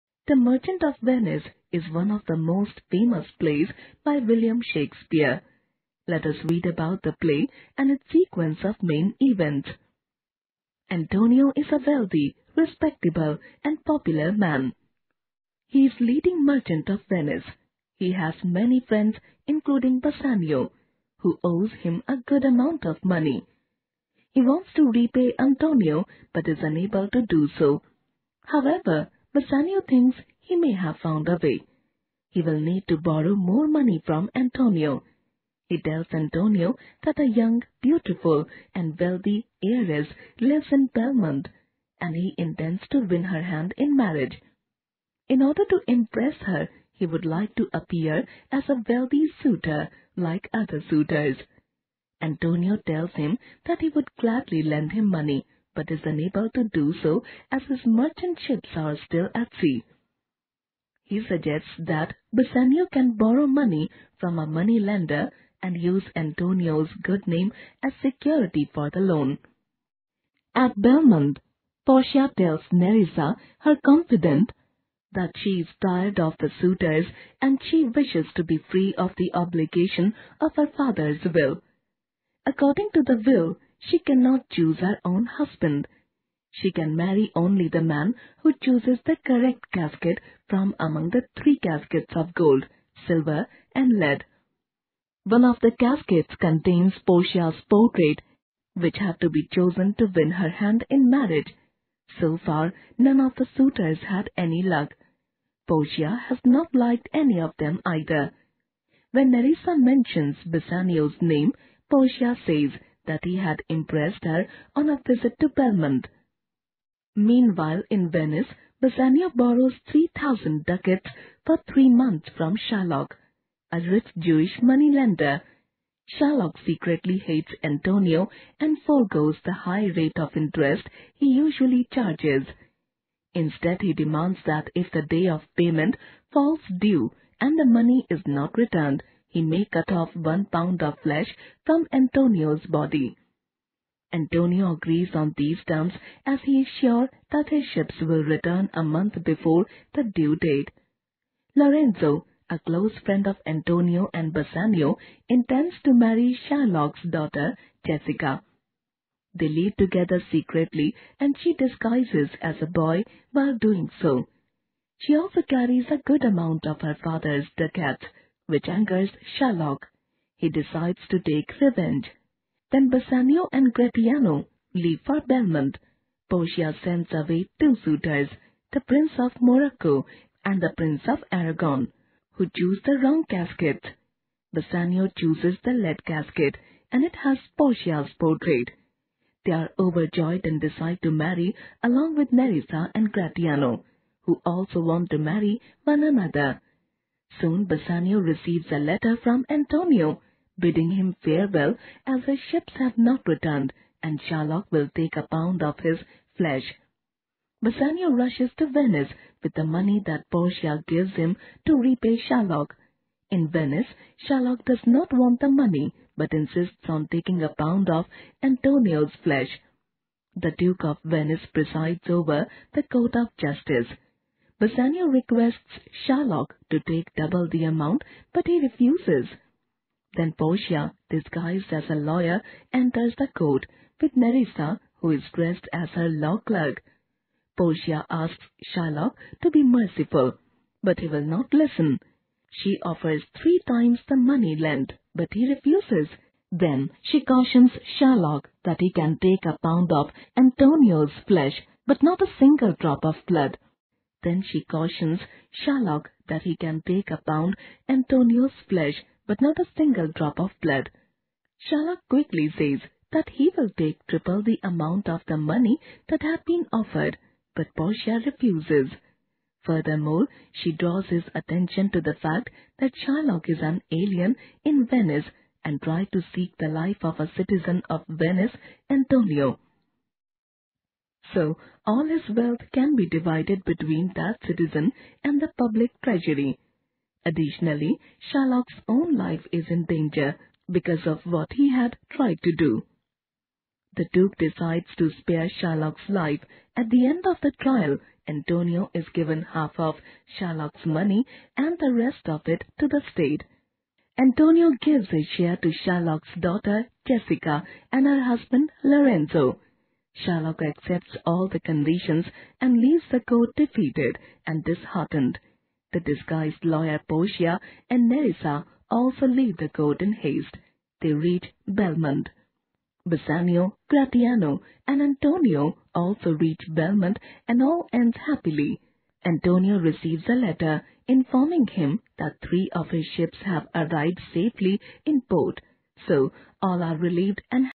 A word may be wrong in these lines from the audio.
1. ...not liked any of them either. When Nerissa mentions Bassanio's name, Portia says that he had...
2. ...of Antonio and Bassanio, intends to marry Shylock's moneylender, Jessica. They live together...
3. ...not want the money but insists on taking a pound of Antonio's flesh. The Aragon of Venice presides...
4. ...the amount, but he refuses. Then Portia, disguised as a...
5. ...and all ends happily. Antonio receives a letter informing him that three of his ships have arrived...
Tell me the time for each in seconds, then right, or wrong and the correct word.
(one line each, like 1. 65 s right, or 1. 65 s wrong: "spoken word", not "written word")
1. 106 s right
2. 153 s wrong: "daughter", not "moneylender"
3. 214 s wrong: "Duke", not "Aragon"
4. 227 s right
5. 327 s right.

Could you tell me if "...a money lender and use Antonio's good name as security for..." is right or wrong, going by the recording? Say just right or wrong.
right.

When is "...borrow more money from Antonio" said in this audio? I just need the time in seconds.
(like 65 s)
32 s.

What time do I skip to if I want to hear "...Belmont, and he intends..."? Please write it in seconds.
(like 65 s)
40 s.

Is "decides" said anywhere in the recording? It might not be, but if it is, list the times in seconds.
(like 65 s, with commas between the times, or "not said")
170 s, 190 s, 294 s.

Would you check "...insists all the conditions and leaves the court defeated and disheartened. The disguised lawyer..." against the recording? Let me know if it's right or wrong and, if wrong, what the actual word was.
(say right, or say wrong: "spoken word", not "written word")
wrong: "accepts", not "insists".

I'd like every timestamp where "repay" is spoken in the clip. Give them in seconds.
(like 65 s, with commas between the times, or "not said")
24 s, 211 s.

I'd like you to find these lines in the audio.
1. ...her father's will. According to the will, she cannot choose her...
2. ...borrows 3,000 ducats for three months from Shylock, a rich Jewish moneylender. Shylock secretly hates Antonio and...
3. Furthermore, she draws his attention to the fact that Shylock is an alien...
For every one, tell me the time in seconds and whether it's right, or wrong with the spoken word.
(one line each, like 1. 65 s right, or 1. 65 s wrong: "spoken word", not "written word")
1. 80 s right
2. 119 s right
3. 269 s right.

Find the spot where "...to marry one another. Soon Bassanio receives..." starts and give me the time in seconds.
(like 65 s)
195 s.